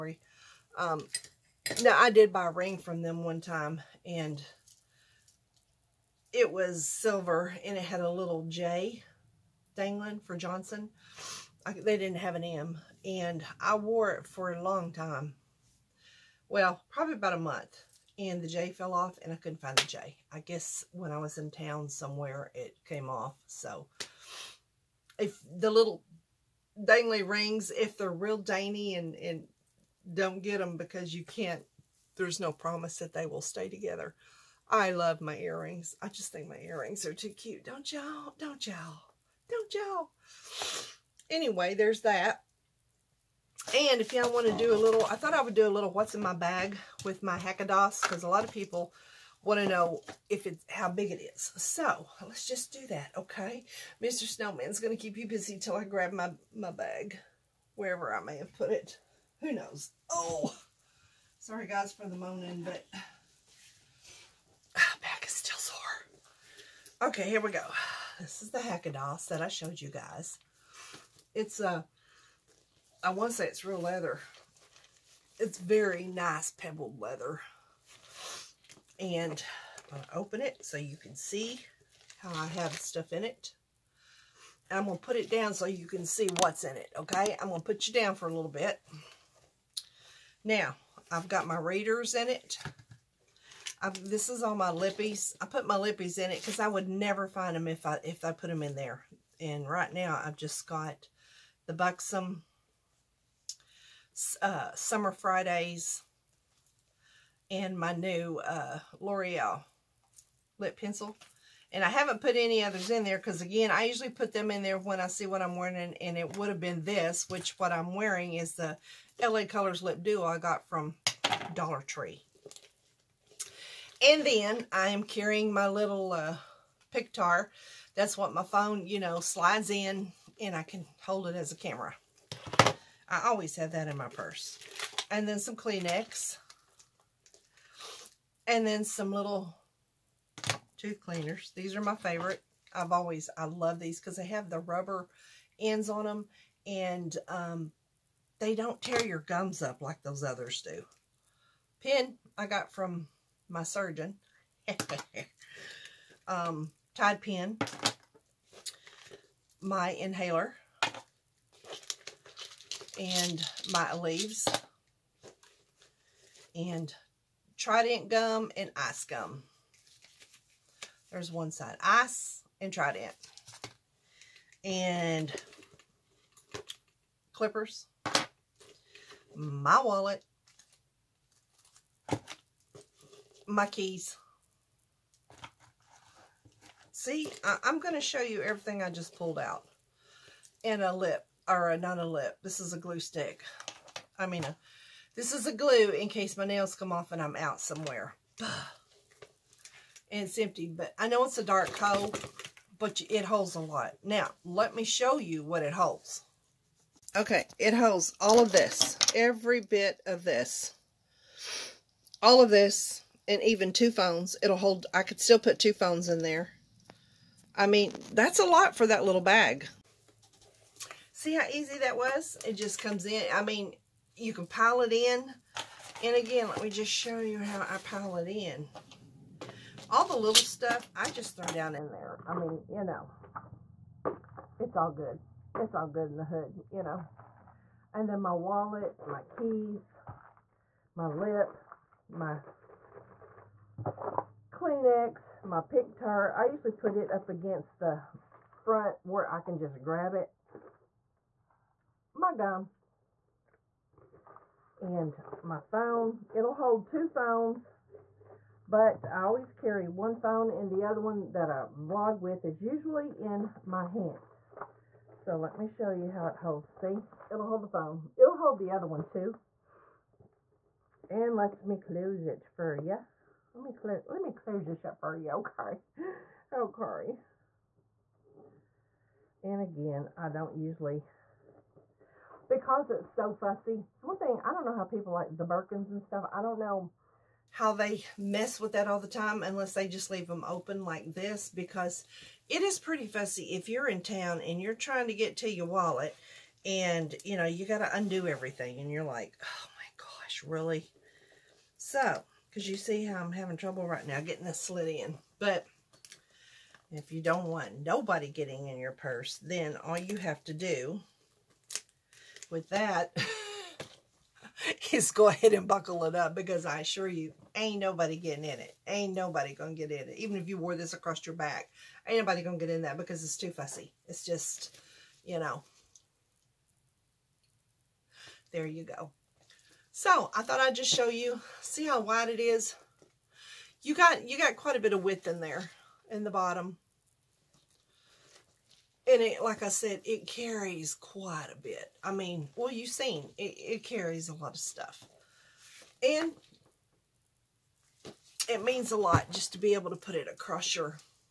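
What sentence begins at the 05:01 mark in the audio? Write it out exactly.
So, because you see how I'm having trouble right now getting this slit in.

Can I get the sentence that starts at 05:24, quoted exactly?
It's just, you know, there you go.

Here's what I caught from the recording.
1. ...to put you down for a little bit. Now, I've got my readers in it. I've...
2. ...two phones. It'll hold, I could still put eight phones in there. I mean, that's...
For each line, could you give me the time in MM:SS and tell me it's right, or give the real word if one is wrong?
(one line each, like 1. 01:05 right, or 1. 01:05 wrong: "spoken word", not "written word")
1. 01:27 right
2. 03:33 wrong: "two", not "eight".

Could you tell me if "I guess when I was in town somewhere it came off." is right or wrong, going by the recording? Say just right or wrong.
right.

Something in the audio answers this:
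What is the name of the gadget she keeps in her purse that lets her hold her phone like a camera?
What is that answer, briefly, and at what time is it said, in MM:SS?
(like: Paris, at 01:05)
Pictar, at 02:06.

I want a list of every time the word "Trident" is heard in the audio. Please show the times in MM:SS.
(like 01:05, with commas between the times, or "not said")
02:47, 02:52.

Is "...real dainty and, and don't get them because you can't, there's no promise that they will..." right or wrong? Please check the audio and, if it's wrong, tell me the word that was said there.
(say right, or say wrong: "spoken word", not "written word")
right.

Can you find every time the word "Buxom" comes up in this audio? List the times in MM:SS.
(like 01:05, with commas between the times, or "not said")
01:41.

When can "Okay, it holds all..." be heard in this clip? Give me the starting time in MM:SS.
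03:27.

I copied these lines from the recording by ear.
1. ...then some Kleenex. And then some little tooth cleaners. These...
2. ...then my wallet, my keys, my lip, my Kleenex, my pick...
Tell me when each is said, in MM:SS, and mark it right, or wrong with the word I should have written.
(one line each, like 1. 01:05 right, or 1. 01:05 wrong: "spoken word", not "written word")
1. 02:15 right
2. 03:58 right.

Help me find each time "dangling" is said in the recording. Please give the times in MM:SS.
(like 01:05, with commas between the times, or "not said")
00:09.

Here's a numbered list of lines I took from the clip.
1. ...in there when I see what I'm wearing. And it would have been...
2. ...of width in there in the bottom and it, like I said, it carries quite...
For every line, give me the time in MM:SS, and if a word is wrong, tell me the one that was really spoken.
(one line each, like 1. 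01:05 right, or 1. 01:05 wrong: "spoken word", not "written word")
1. 01:54 right
2. 05:34 right.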